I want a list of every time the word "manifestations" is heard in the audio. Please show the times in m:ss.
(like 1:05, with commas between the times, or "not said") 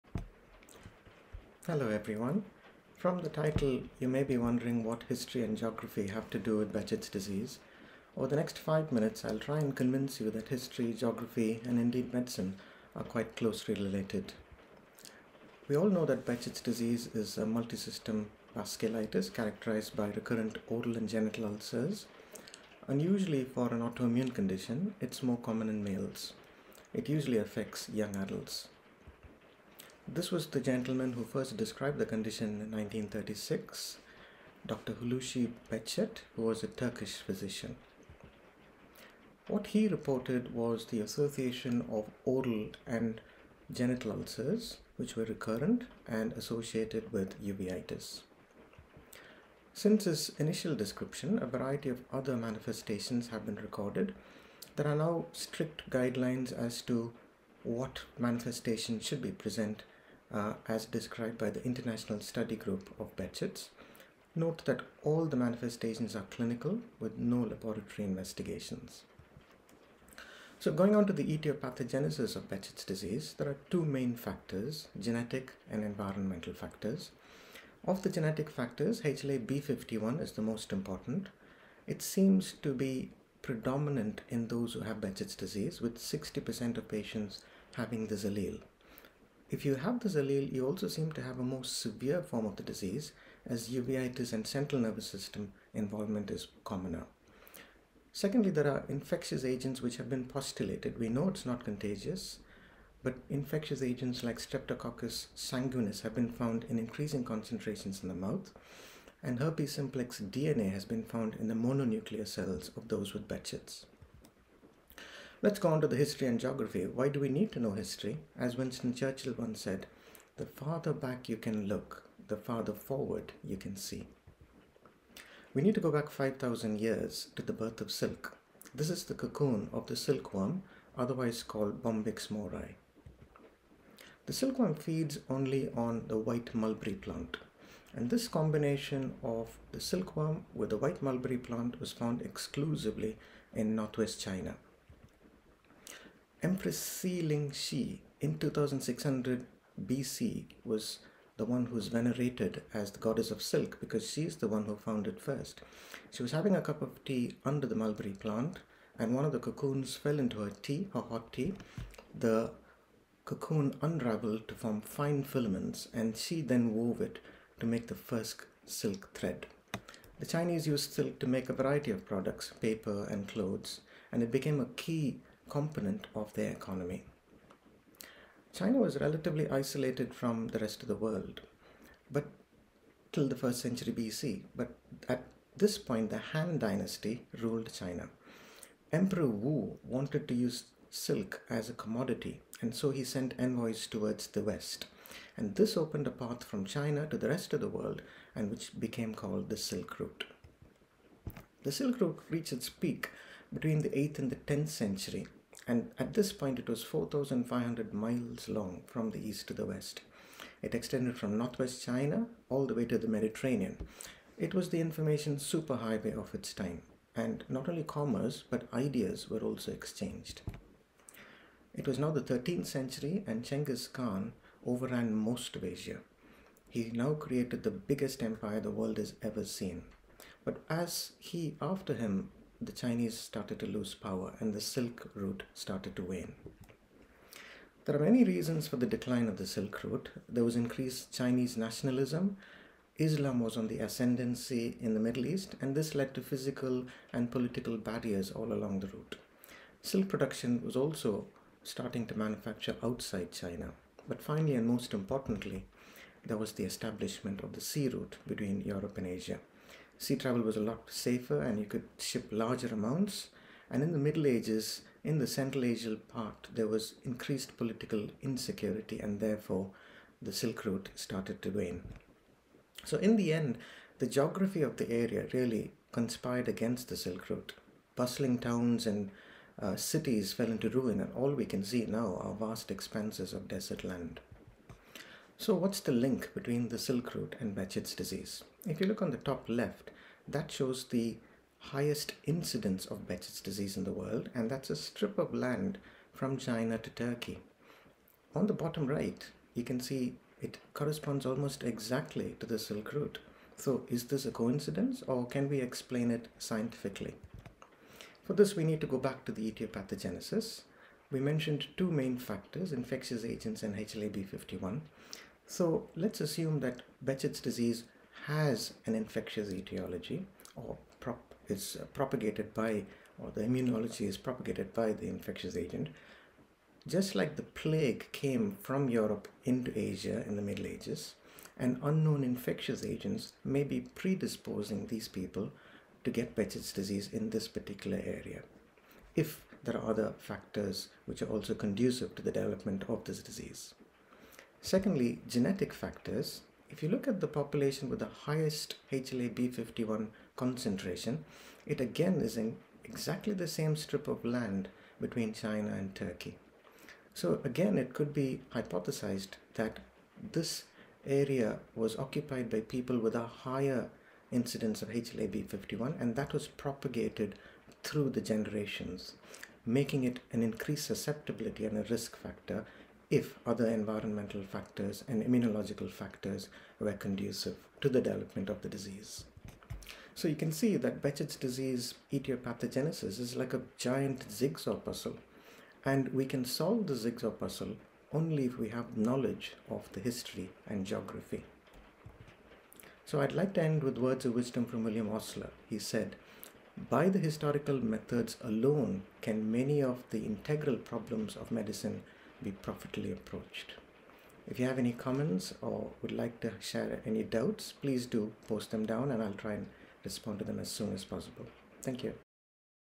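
0:52, 0:58, 1:05.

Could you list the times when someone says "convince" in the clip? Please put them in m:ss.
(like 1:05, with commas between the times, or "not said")
0:09.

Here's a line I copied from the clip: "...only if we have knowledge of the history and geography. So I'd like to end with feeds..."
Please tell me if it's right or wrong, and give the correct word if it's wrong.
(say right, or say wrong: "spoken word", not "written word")
wrong: "words", not "feeds".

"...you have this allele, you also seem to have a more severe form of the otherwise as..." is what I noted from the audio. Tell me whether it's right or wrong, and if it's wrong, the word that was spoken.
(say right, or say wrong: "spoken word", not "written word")
wrong: "disease", not "otherwise".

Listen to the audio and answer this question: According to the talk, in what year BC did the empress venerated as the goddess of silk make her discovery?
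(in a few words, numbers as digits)
2600 BC.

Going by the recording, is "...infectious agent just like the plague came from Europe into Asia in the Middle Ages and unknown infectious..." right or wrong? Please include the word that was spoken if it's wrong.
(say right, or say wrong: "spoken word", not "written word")
right.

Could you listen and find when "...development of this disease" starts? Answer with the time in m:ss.
5:42.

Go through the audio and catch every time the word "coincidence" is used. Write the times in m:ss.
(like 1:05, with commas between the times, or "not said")
5:04.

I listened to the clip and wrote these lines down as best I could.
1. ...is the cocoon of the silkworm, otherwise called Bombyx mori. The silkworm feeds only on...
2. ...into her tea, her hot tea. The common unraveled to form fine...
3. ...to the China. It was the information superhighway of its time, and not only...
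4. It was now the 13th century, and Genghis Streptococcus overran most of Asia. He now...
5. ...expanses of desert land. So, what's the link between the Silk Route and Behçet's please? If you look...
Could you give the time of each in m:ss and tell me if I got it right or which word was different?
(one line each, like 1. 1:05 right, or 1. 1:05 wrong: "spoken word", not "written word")
1. 2:08 right
2. 2:40 wrong: "cocoon", not "common"
3. 3:32 wrong: "Mediterranean", not "China"
4. 3:41 wrong: "Khan", not "Streptococcus"
5. 4:42 wrong: "disease", not "please".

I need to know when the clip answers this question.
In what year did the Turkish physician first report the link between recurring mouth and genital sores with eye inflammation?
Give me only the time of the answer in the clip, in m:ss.
0:32.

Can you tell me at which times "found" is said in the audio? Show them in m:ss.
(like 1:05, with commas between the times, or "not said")
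1:46, 1:51, 2:21, 2:34.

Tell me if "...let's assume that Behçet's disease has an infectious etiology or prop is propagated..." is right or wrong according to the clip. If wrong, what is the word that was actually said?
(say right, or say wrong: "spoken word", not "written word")
right.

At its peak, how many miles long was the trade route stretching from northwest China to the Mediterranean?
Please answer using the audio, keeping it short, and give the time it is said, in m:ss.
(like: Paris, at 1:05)
4,500 miles, at 3:26.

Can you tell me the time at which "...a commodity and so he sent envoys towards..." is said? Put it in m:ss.
3:11.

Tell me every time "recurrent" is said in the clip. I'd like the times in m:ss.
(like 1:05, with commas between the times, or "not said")
0:20, 0:45.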